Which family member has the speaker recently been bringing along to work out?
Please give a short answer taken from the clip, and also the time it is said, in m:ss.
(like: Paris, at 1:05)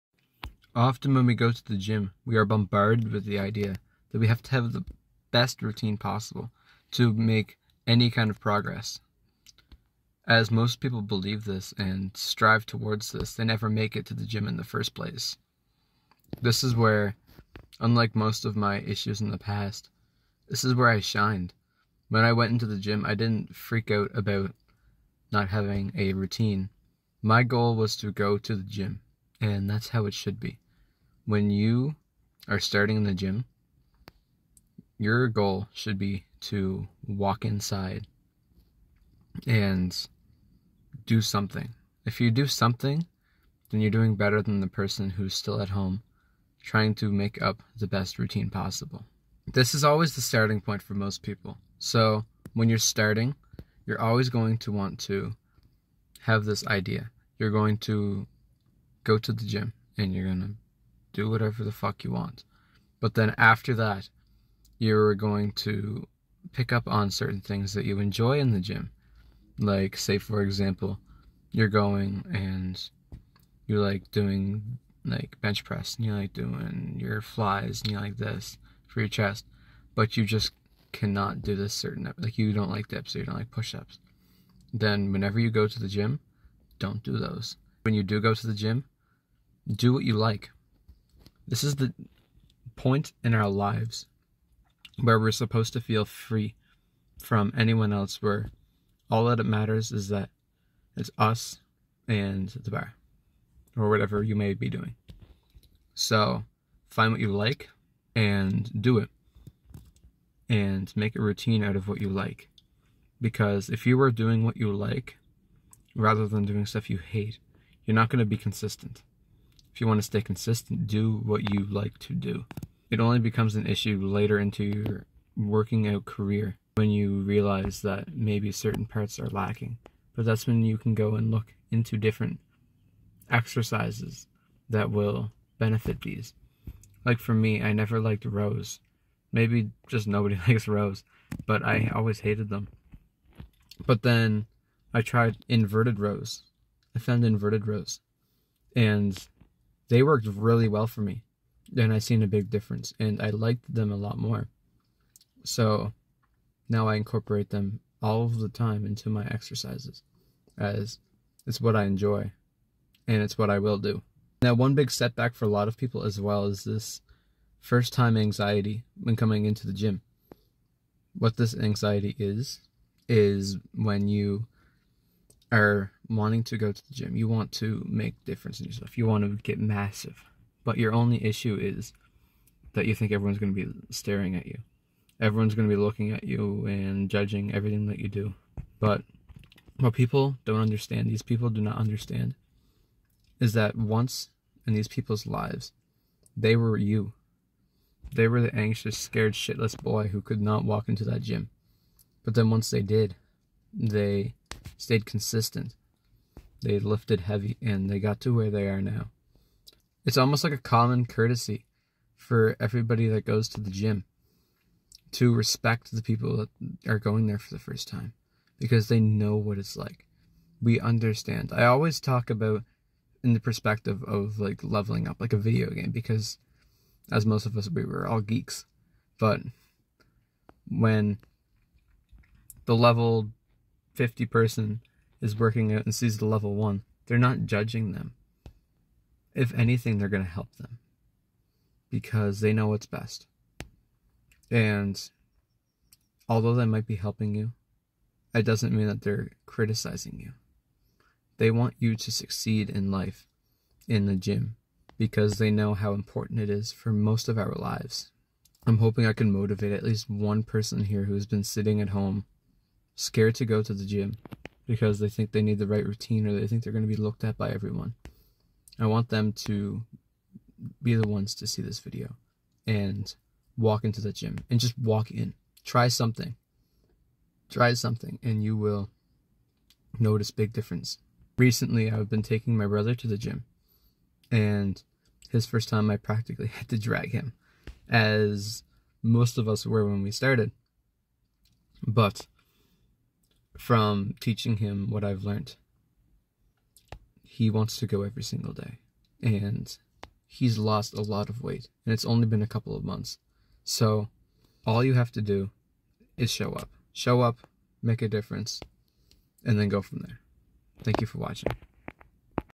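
brother, at 4:42.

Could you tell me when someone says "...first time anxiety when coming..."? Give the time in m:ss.
2:47.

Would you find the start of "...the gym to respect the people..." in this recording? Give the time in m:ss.
3:33.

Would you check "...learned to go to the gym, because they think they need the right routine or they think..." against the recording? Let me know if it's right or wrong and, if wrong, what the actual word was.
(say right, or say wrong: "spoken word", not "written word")
wrong: "scared", not "learned".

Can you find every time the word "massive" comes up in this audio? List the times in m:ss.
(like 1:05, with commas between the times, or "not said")
2:59.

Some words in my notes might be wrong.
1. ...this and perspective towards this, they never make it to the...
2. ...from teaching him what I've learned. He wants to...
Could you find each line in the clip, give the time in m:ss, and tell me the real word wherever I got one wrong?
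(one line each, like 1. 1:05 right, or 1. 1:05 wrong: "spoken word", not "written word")
1. 0:11 wrong: "strive", not "perspective"
2. 4:53 right.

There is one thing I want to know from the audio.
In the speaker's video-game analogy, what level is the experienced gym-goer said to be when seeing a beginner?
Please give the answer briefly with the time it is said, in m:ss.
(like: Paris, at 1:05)
50, at 3:52.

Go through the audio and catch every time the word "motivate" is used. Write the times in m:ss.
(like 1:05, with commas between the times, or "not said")
4:19.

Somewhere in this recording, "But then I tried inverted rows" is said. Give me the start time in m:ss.
2:23.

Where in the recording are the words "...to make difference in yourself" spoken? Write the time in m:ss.
2:57.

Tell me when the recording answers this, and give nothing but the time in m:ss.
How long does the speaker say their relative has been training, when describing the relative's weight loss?
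5:02.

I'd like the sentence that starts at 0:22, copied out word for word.
When I went into the gym, I didn't freak out about not having a routine.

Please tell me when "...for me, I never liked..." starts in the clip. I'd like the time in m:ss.
2:17.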